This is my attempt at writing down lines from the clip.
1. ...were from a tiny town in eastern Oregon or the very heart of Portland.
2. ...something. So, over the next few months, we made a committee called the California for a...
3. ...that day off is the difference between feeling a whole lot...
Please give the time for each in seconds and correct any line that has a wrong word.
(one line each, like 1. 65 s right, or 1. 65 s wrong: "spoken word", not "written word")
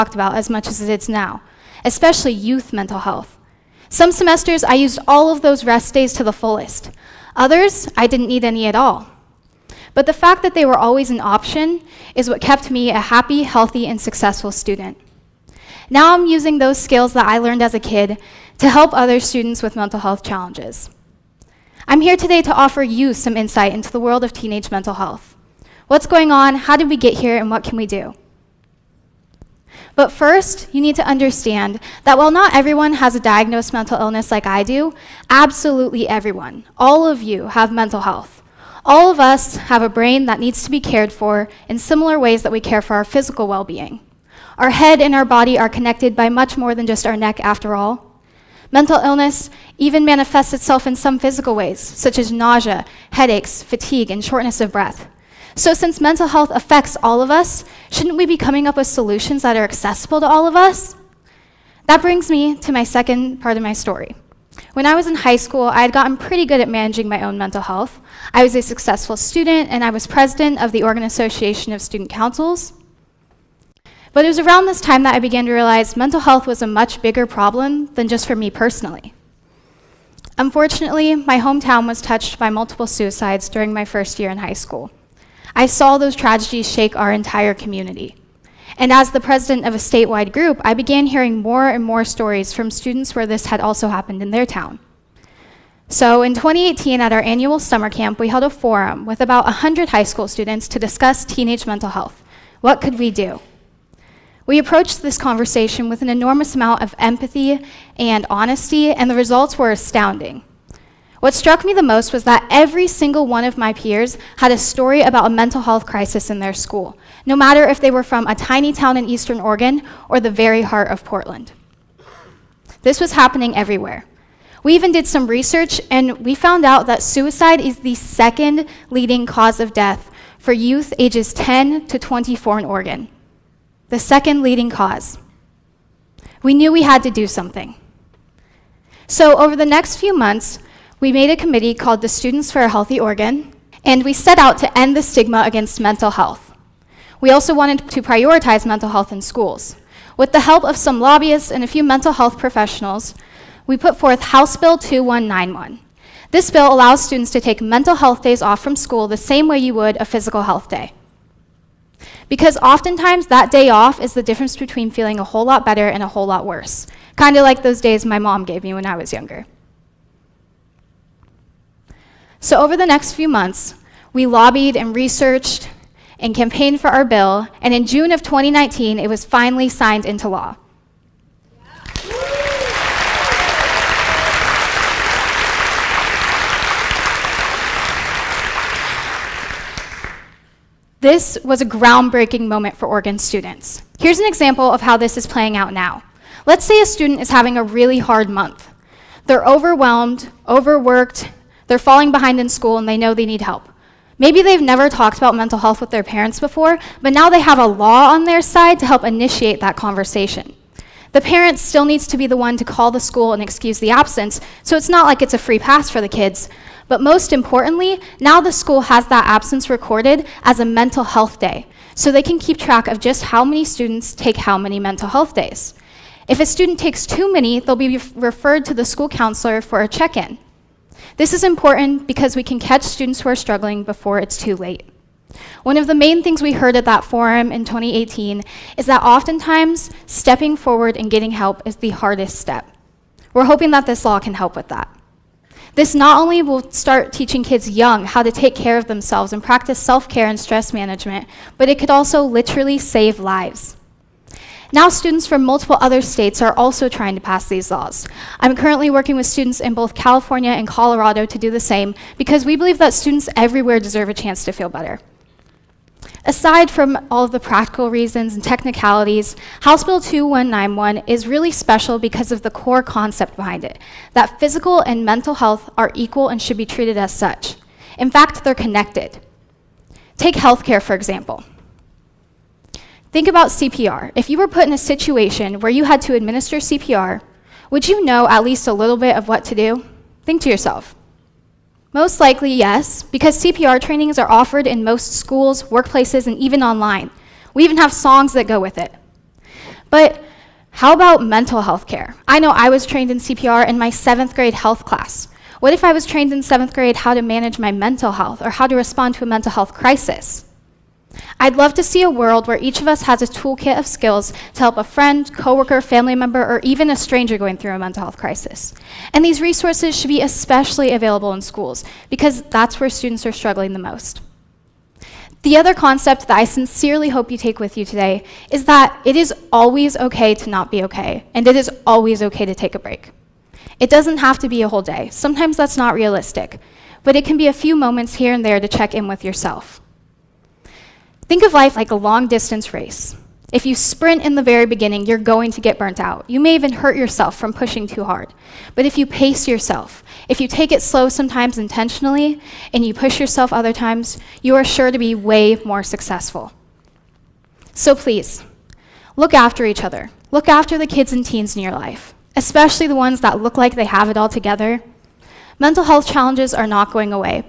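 1. 117 s right
2. 137 s wrong: "Students", not "California"
3. 163 s right.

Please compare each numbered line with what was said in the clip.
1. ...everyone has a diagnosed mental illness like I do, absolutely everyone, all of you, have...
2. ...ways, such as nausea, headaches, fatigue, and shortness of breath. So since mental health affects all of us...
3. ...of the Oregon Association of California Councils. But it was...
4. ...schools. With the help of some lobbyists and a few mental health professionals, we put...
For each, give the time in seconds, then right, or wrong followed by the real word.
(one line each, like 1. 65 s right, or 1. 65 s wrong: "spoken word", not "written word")
1. 32 s right
2. 51 s right
3. 70 s wrong: "Student", not "California"
4. 149 s right.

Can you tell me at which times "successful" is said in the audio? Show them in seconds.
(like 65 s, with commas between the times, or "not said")
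13 s, 68 s, 355 s.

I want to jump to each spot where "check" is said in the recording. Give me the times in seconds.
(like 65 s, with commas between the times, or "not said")
229 s, 338 s.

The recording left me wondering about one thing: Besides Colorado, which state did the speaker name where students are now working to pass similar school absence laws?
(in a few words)
California.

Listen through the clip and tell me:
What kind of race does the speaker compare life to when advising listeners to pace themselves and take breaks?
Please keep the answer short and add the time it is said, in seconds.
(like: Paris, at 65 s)
long distance race, at 341 s.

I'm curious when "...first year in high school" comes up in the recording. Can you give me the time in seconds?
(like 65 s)
83 s.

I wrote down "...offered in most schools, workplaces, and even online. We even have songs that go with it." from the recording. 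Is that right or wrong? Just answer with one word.
right.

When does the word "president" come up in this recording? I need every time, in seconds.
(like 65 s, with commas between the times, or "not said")
70 s, 89 s.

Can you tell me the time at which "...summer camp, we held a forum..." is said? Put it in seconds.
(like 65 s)
97 s.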